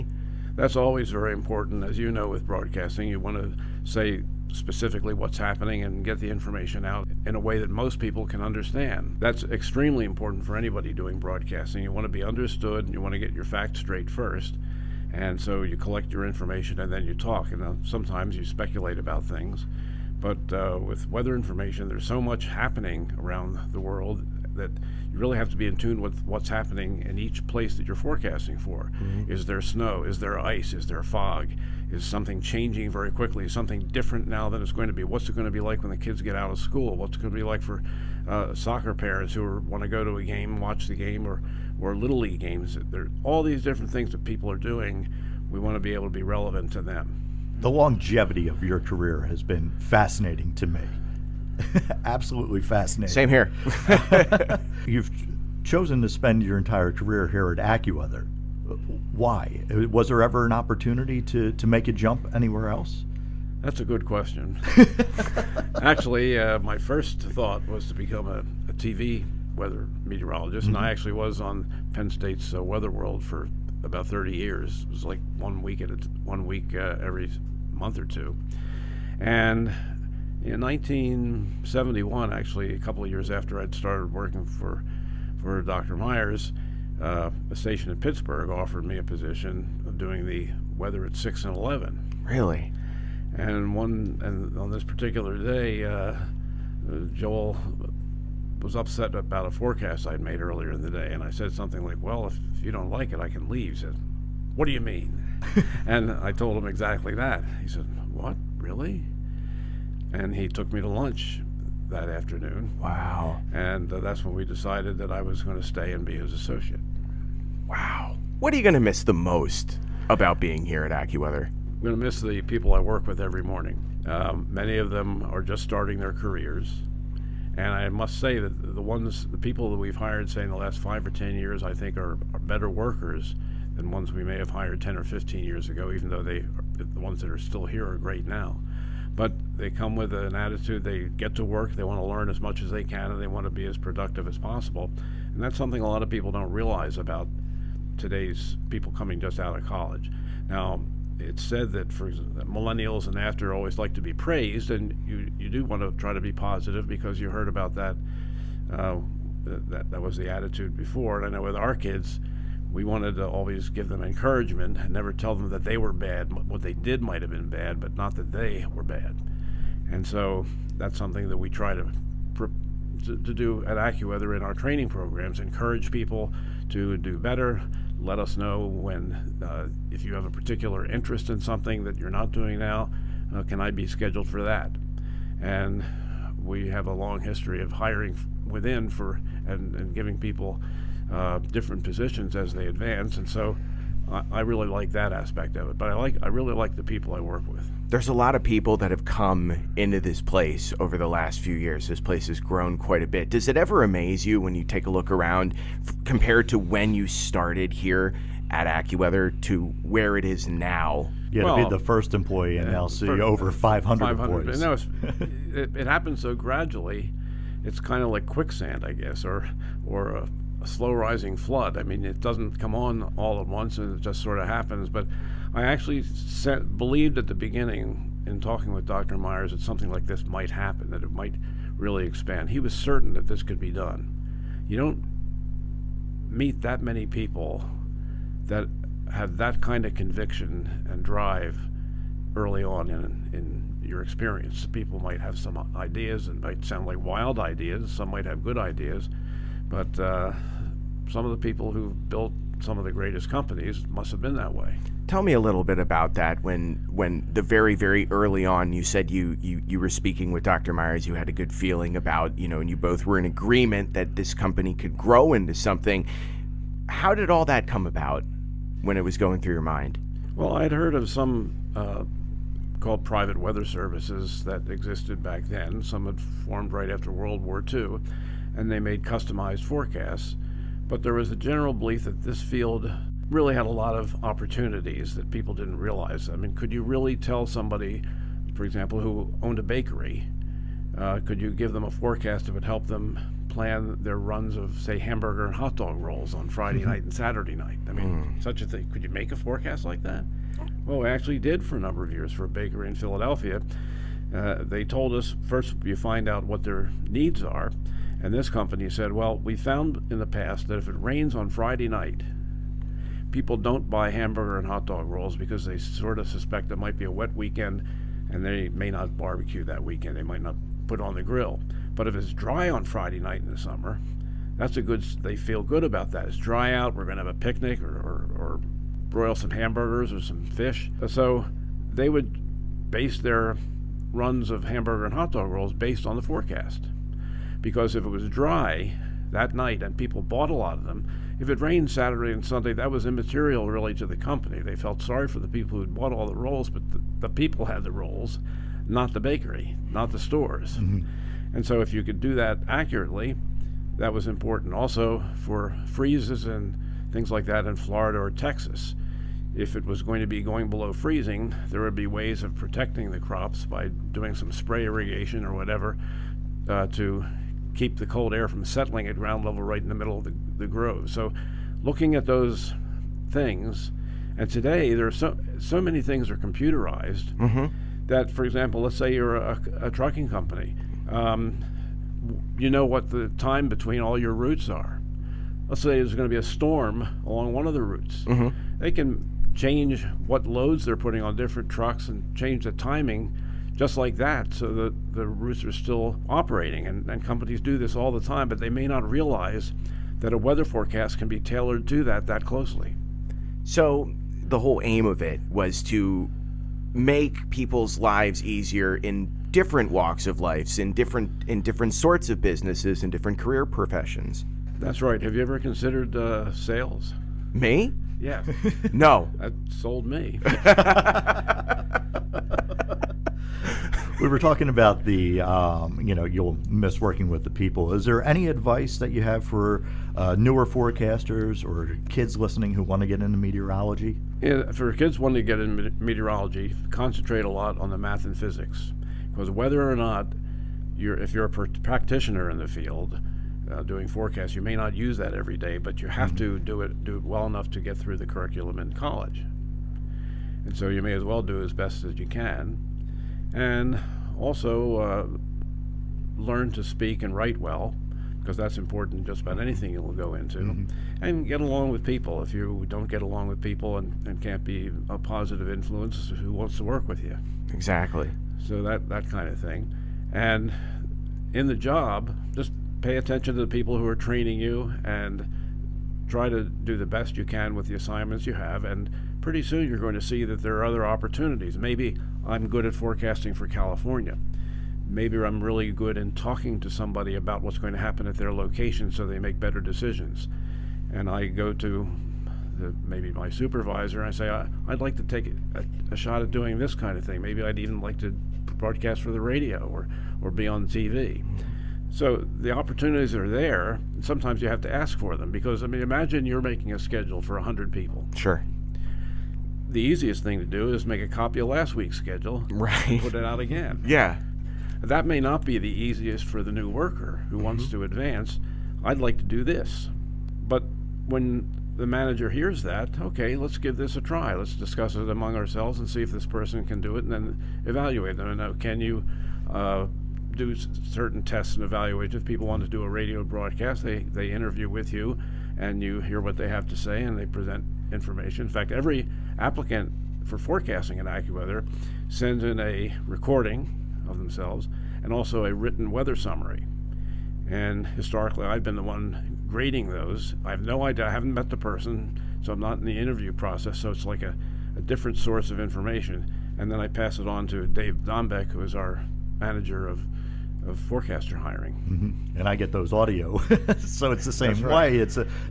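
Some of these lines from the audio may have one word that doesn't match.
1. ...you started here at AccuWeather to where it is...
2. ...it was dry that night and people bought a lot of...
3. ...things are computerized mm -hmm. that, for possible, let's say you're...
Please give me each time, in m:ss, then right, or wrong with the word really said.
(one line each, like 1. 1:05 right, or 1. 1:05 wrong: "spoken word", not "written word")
1. 3:26 right
2. 5:38 right
3. 6:16 wrong: "example", not "possible".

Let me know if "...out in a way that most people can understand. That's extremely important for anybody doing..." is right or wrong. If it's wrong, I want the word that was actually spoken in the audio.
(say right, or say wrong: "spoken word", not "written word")
right.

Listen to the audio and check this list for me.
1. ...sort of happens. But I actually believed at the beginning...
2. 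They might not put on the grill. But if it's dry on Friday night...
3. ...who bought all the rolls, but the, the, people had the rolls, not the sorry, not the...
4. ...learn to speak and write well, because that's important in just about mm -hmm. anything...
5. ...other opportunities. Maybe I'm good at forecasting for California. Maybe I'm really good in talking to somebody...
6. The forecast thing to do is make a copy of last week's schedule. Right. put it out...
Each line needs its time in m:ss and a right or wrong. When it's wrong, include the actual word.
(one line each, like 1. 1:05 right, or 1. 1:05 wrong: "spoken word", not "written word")
1. 3:44 right
2. 5:20 right
3. 5:45 wrong: "bakery", not "sorry"
4. 7:36 right
5. 8:00 right
6. 8:29 wrong: "easiest", not "forecast".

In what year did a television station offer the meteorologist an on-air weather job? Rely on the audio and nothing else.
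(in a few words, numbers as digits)
1971.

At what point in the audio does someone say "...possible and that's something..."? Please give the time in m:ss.
2:24.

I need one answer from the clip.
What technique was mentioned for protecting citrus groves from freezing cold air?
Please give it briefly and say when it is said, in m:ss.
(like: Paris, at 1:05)
Spray irrigation, at 6:04.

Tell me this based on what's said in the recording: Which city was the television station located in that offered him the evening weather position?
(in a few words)
Pittsburgh.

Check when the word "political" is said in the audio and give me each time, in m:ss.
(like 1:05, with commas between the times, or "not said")
not said.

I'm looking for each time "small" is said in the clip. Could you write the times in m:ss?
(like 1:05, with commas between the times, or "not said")
not said.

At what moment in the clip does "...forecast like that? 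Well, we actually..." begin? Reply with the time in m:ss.
4:59.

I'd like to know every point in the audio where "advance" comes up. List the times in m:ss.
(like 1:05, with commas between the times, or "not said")
3:12, 8:38.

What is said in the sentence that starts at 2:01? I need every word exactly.
I'm going to miss the people I work with every morning.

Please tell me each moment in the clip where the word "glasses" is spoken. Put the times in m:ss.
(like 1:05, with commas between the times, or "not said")
not said.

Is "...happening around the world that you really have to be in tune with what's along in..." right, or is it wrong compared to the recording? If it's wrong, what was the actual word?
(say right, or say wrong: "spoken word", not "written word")
wrong: "happening", not "along".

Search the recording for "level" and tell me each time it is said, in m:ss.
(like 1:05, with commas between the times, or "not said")
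6:09.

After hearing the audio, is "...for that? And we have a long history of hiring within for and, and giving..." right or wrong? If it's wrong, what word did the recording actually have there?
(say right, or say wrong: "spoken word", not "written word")
right.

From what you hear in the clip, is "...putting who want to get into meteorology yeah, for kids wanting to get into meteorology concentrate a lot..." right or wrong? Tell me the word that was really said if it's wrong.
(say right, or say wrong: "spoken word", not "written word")
wrong: "listening", not "putting".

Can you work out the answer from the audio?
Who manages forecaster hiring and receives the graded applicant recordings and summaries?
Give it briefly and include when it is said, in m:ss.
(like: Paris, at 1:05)
Dave Dombek, at 9:17.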